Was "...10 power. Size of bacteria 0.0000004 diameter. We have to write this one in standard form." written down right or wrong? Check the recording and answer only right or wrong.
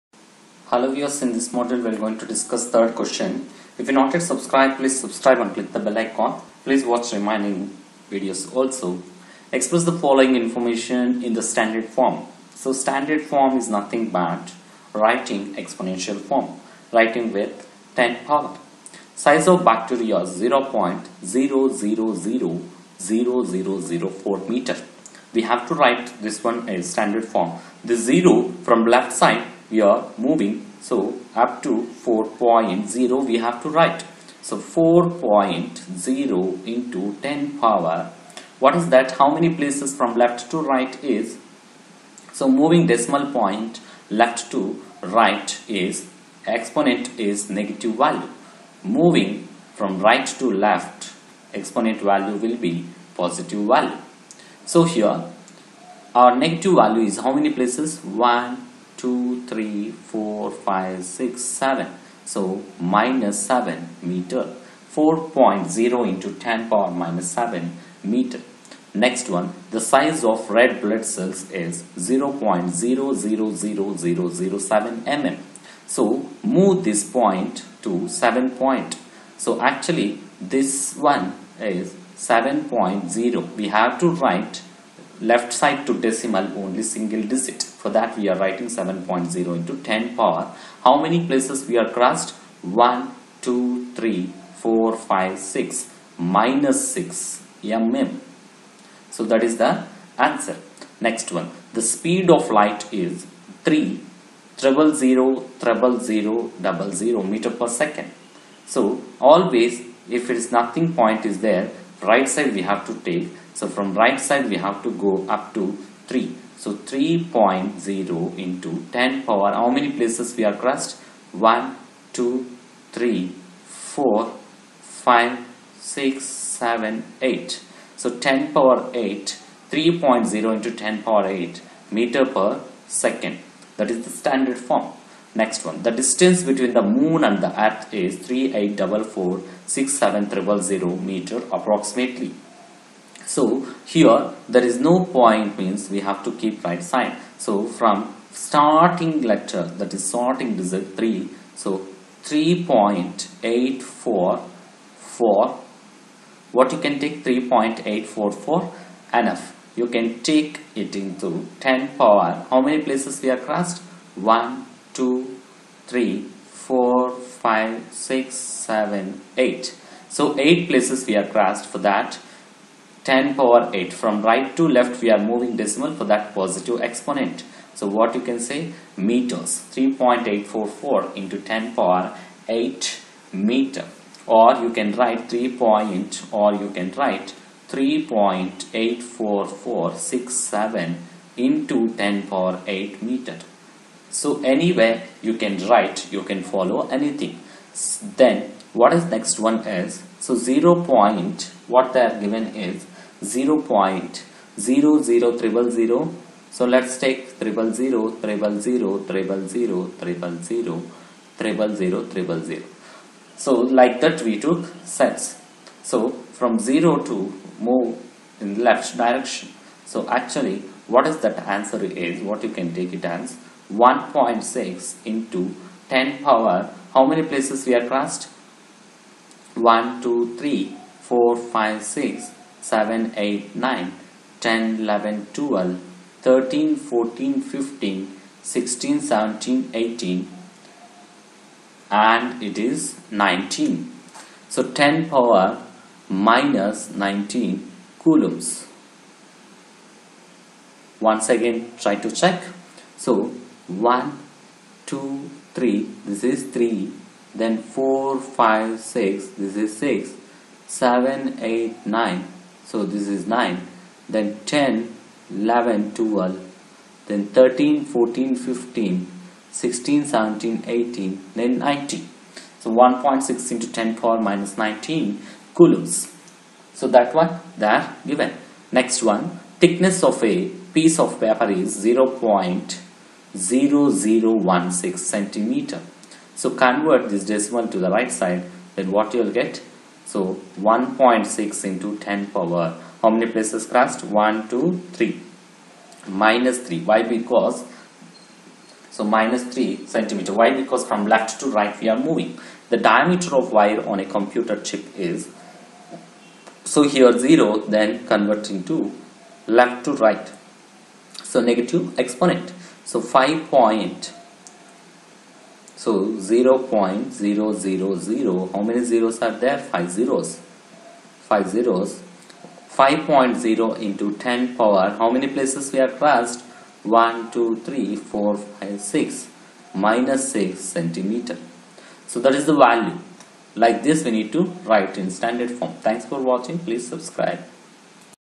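wrong.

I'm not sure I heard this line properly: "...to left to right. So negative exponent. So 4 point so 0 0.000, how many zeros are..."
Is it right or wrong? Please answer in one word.
wrong.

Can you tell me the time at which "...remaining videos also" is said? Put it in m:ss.
0:07.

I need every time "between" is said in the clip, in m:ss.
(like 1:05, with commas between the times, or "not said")
2:16.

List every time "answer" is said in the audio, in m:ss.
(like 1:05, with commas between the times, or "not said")
1:40, 3:41.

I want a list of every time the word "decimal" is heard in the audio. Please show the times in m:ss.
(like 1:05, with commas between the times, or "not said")
0:42, 1:26, 2:55, 4:47.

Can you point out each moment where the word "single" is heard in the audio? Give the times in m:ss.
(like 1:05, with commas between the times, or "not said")
1:26.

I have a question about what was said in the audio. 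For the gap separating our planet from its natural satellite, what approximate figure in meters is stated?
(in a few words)
38446700.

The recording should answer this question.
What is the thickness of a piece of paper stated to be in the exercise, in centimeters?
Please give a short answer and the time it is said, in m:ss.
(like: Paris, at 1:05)
0.0016, at 4:41.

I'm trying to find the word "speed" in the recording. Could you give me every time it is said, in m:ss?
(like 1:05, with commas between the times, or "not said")
1:41.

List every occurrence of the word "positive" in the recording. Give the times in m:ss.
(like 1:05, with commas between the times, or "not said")
0:53, 2:56.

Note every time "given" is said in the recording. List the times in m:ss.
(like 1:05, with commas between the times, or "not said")
3:22, 4:38.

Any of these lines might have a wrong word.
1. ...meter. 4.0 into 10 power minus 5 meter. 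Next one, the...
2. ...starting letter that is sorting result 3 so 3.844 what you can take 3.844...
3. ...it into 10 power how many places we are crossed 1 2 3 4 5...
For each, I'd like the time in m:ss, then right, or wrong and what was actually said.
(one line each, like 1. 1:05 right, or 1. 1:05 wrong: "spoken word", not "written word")
1. 1:04 wrong: "7", not "5"
2. 2:28 right
3. 2:40 right.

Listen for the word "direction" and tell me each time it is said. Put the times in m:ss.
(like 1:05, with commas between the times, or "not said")
3:38.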